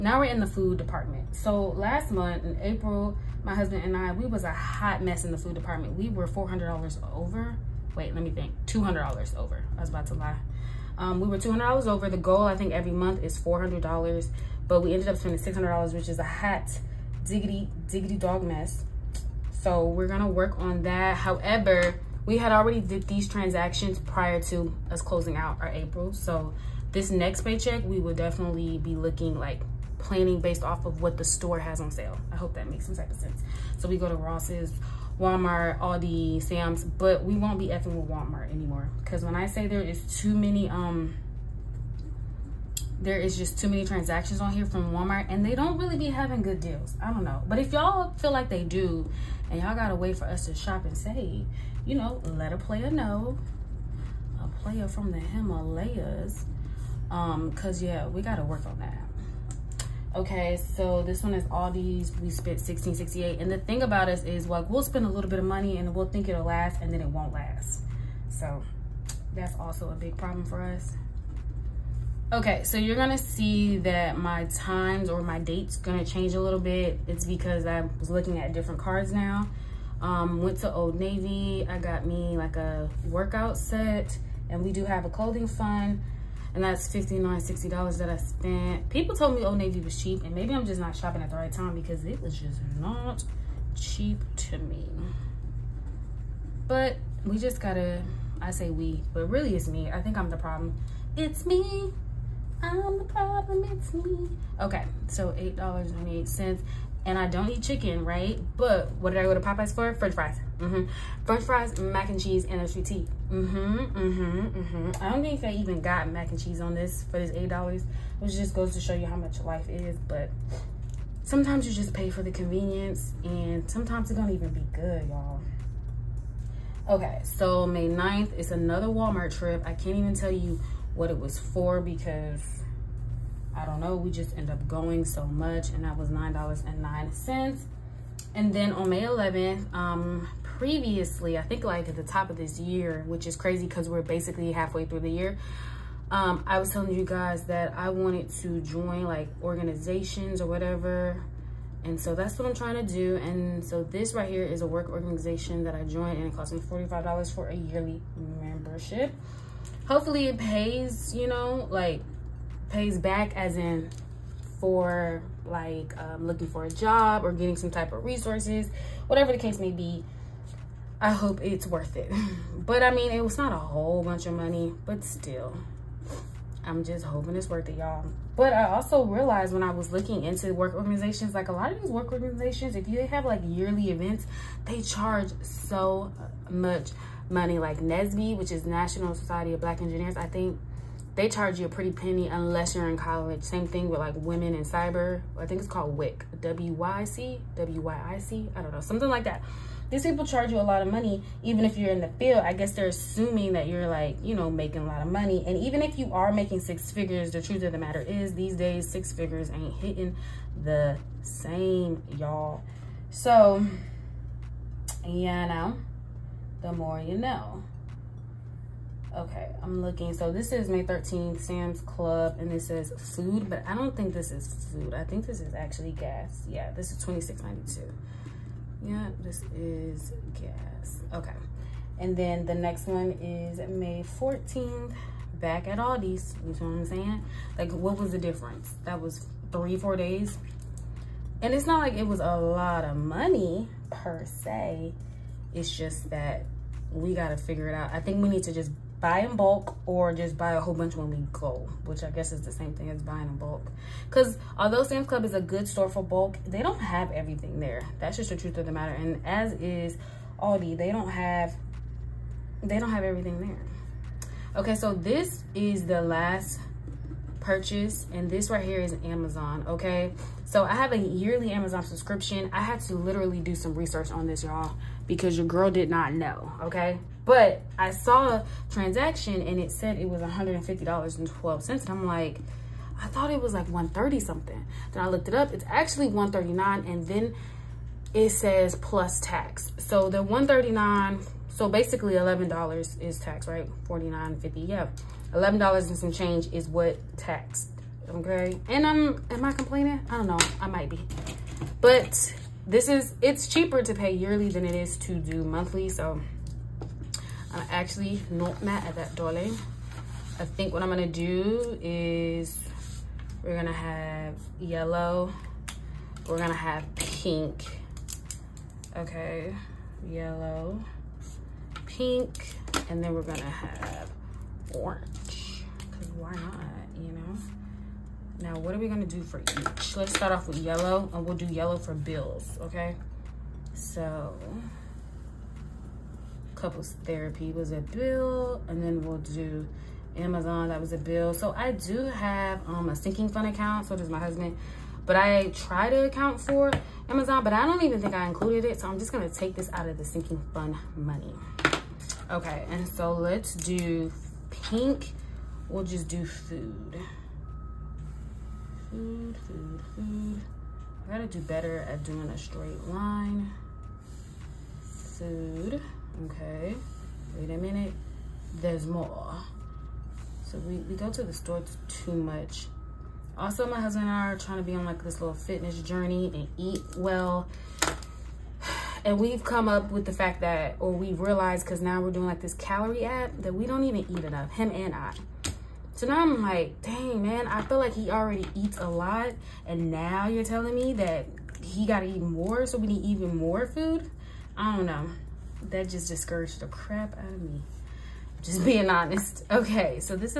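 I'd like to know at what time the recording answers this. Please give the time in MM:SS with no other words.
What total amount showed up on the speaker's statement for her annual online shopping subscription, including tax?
04:40.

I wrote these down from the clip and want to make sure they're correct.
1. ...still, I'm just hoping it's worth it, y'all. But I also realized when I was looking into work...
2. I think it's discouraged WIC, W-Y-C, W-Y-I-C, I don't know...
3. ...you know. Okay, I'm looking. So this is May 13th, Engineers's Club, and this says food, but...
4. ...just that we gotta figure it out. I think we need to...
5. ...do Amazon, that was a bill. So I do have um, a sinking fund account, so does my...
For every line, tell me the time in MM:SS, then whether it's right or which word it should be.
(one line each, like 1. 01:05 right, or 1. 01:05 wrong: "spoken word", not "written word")
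1. 02:55 right
2. 03:15 wrong: "called", not "discouraged"
3. 03:36 wrong: "Sam", not "Engineers"
4. 04:05 right
5. 05:39 right.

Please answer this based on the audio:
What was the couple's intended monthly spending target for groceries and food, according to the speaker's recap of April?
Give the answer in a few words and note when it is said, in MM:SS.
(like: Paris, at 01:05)
$400, at 00:12.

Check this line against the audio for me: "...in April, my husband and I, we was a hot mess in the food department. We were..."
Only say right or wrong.
right.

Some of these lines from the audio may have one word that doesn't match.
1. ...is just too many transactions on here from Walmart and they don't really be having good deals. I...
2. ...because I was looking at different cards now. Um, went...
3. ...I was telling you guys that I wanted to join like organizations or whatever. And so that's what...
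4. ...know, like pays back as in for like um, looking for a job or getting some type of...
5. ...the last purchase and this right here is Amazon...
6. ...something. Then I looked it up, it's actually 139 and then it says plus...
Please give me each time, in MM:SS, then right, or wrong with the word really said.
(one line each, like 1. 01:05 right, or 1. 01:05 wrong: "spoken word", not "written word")
1. 00:43 right
2. 01:17 right
3. 02:26 right
4. 02:41 right
5. 04:25 right
6. 04:44 right.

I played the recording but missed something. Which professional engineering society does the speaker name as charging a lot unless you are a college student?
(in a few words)
National Society of Black Engineers.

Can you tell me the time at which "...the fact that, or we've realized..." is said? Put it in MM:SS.
06:20.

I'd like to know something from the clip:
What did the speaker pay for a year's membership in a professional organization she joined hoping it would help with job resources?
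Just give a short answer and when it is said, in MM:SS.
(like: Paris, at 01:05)
$45, at 02:36.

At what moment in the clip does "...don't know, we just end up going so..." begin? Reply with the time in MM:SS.
02:13.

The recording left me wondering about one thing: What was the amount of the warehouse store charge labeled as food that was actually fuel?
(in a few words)
$26.92.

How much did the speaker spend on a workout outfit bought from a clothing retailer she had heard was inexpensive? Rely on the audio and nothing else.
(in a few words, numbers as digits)
$59.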